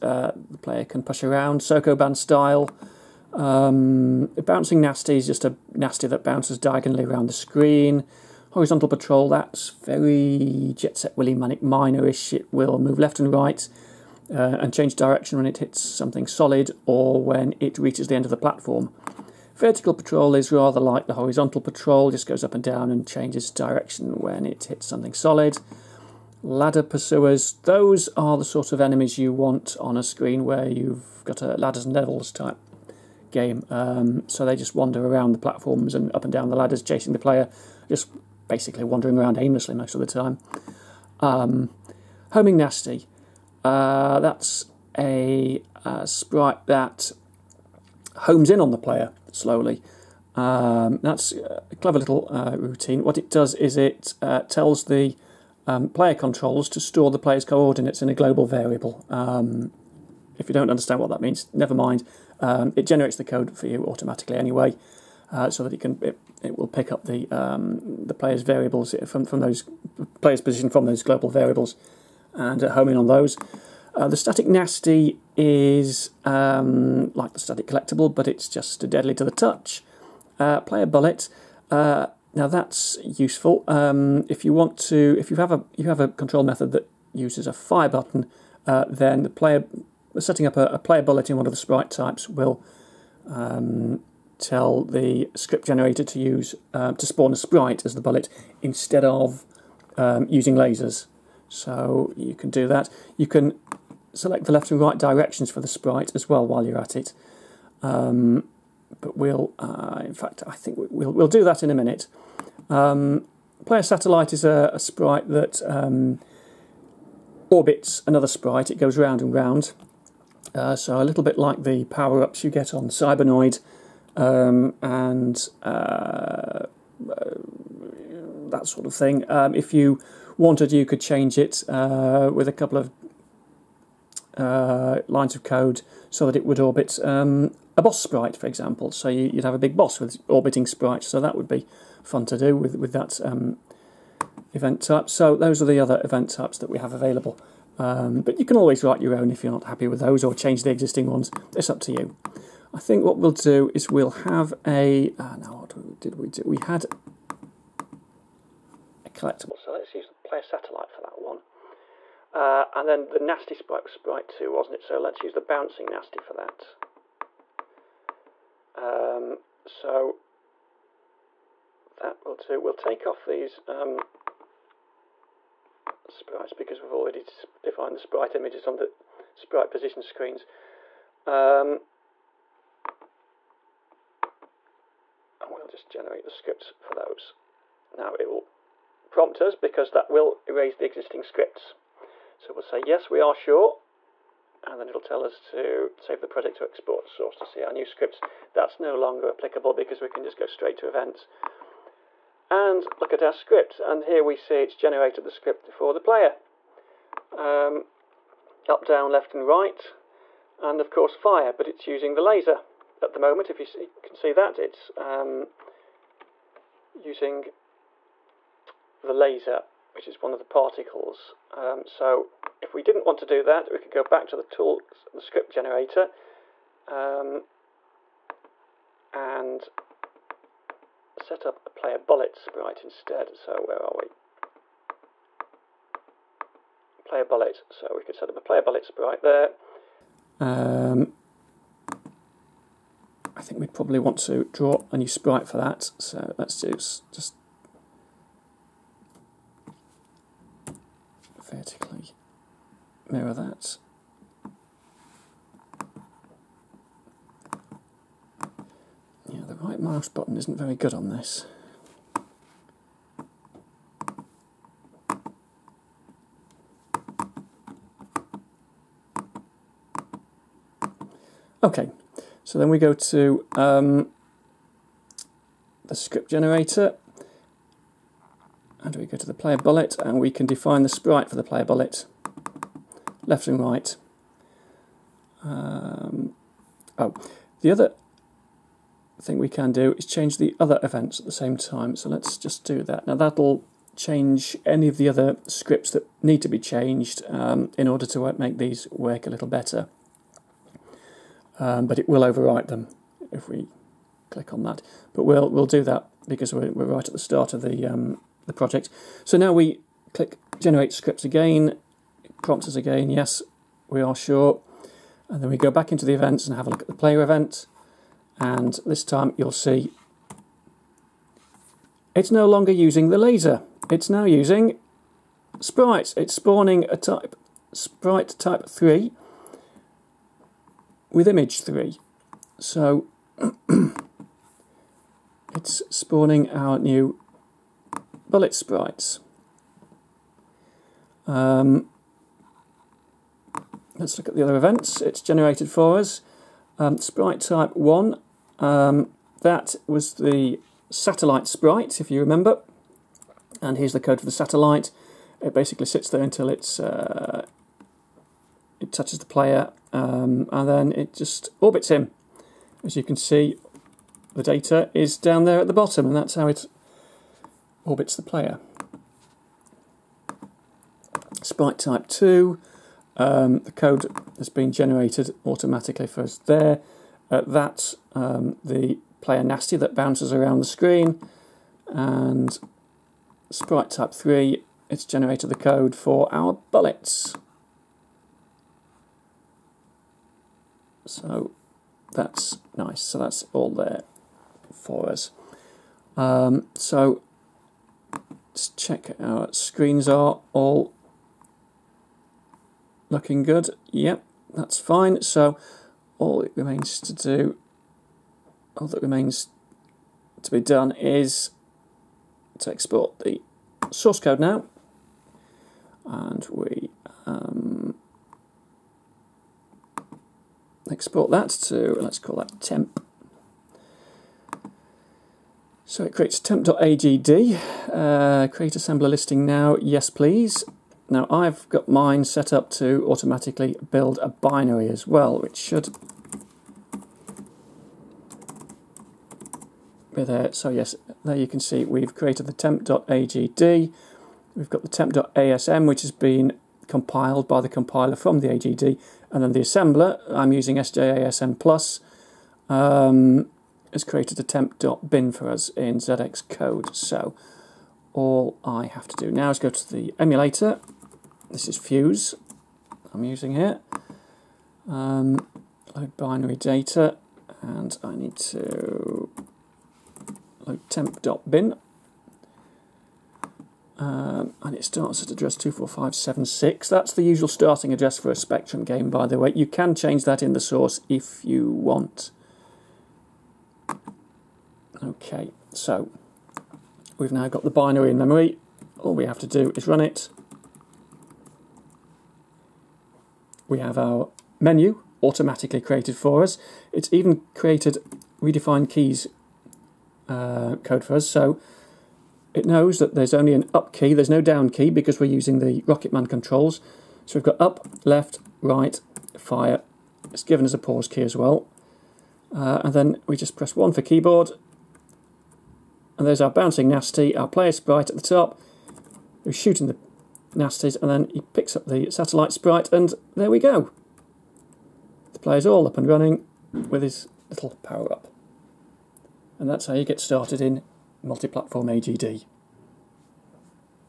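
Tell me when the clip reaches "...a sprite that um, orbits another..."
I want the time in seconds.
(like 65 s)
114 s.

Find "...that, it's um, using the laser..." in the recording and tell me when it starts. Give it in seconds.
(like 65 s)
214 s.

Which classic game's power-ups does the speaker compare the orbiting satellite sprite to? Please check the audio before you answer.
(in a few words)
Cybernoid.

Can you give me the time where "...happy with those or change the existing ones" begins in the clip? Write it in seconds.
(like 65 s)
149 s.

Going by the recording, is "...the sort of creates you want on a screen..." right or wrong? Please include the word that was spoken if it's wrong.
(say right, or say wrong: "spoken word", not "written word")
wrong: "enemies", not "creates".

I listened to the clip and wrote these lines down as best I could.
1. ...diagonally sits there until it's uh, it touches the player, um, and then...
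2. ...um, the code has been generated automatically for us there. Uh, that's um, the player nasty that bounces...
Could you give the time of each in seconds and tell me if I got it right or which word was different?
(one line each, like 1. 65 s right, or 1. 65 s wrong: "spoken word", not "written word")
1. 355 s wrong: "basically", not "diagonally"
2. 373 s right.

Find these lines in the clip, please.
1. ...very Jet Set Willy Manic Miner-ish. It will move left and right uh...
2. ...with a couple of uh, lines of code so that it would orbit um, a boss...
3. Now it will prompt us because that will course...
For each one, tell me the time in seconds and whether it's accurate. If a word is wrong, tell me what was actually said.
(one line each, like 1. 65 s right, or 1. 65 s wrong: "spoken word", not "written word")
1. 9 s right
2. 132 s right
3. 187 s wrong: "erase", not "course".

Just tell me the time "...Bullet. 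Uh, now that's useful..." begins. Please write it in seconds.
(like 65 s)
80 s.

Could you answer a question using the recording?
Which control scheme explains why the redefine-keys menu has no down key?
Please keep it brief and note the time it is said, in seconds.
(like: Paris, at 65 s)
Rocketman controls, at 505 s.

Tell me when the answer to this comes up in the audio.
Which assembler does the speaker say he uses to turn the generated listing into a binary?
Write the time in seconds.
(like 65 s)
450 s.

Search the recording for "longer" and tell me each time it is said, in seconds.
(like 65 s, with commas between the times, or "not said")
198 s, 322 s.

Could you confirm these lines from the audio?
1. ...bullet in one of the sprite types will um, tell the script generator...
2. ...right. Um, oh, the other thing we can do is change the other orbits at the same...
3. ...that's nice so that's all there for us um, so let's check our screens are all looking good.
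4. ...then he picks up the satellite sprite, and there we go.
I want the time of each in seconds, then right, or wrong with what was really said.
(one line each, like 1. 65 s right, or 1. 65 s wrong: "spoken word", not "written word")
1. 91 s right
2. 283 s wrong: "events", not "orbits"
3. 392 s right
4. 521 s right.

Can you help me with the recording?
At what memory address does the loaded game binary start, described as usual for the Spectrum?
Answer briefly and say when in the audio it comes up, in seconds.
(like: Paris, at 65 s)
24576, at 475 s.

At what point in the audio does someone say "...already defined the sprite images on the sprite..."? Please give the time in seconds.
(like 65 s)
176 s.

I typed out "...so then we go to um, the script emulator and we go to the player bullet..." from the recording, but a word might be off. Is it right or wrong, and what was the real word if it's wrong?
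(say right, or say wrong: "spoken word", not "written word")
wrong: "generator", not "emulator".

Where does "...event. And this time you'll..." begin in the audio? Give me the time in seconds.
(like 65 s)
317 s.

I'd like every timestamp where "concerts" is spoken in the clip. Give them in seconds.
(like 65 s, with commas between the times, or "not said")
312 s.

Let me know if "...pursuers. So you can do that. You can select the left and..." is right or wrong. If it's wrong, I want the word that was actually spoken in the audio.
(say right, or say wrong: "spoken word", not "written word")
wrong: "lasers", not "pursuers".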